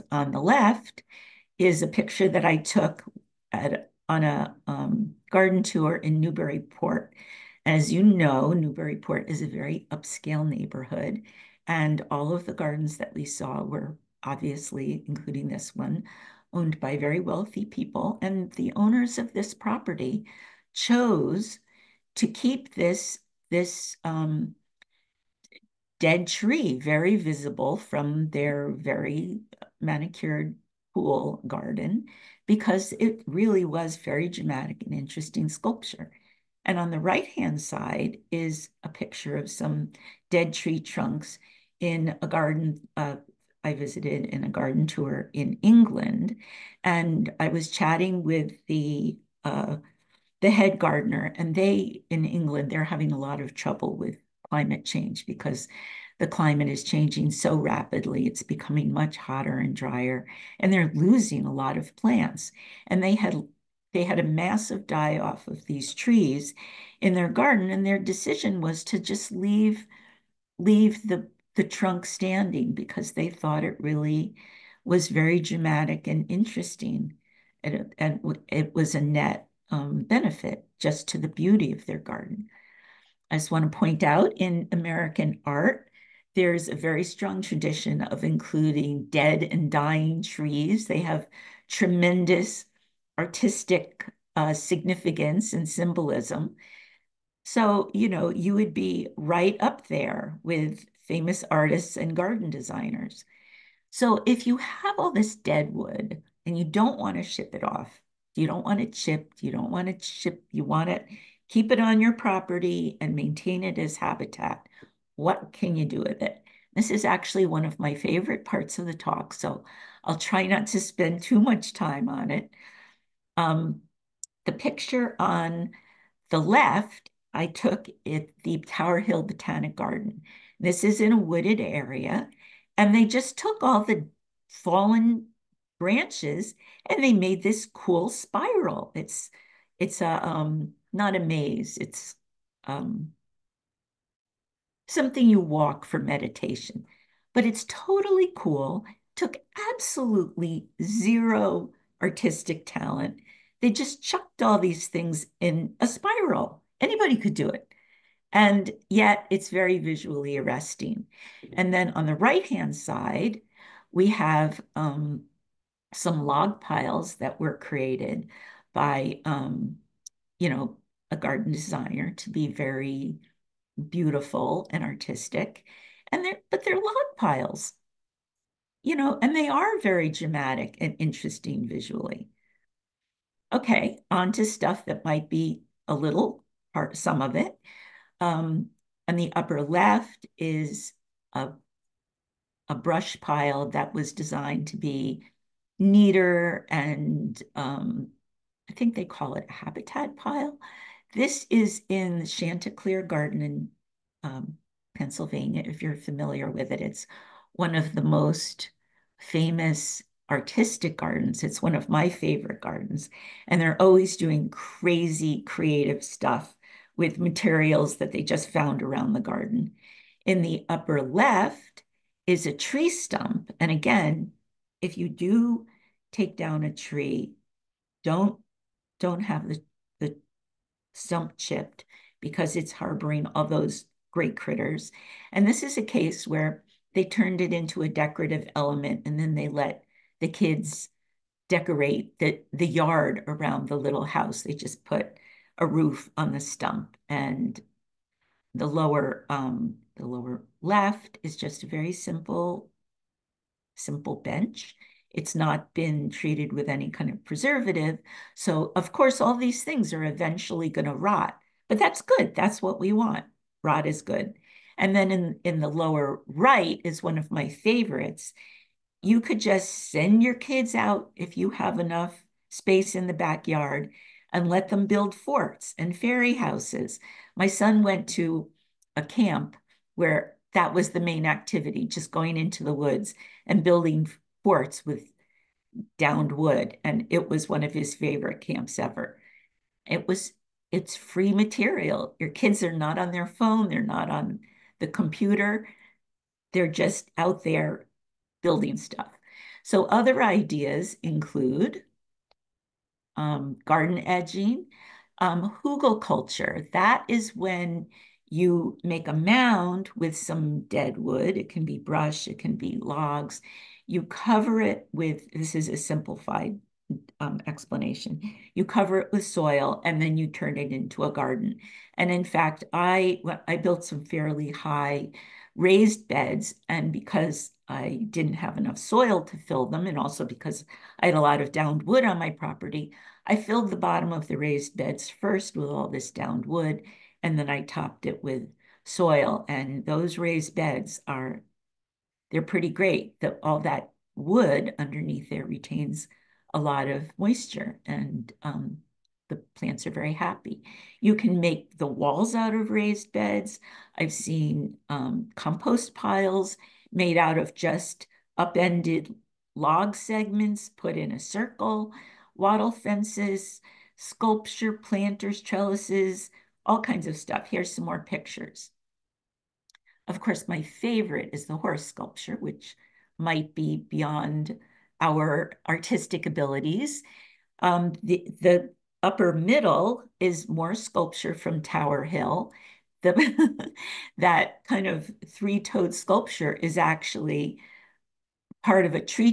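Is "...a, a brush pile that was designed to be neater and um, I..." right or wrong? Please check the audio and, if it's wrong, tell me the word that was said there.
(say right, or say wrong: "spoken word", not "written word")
right.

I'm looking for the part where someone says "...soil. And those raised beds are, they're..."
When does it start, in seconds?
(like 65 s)
338 s.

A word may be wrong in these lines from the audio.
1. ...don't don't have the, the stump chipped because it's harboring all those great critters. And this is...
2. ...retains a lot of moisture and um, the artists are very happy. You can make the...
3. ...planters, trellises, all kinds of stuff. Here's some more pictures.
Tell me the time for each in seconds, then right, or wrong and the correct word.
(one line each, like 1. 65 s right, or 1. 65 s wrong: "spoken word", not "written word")
1. 228 s right
2. 345 s wrong: "plants", not "artists"
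3. 364 s right.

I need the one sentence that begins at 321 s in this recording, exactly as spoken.
And in fact, I, I built some fairly high raised beds.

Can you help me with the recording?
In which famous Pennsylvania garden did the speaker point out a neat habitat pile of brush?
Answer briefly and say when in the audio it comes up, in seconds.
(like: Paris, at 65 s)
Chanticleer Garden, at 202 s.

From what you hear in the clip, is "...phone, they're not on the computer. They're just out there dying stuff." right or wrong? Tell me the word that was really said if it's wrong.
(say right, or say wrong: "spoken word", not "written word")
wrong: "building", not "dying".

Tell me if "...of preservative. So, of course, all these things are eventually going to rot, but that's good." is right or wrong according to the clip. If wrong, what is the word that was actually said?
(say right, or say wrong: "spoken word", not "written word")
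right.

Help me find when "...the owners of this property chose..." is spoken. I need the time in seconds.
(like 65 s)
18 s.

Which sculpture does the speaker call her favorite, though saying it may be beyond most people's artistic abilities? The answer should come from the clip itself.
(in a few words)
the horse sculpture.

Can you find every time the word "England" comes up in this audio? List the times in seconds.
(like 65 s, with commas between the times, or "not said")
45 s, 52 s.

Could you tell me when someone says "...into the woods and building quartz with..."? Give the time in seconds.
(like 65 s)
282 s.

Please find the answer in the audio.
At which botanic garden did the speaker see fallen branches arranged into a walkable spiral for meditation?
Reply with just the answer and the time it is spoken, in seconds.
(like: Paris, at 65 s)
Tower Hill Botanic Garden, at 128 s.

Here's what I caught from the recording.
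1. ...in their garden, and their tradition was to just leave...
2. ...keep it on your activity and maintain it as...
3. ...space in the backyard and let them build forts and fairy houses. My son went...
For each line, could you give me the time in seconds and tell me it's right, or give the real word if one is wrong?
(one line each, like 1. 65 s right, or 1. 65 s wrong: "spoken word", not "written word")
1. 67 s wrong: "decision", not "tradition"
2. 111 s wrong: "property", not "activity"
3. 272 s right.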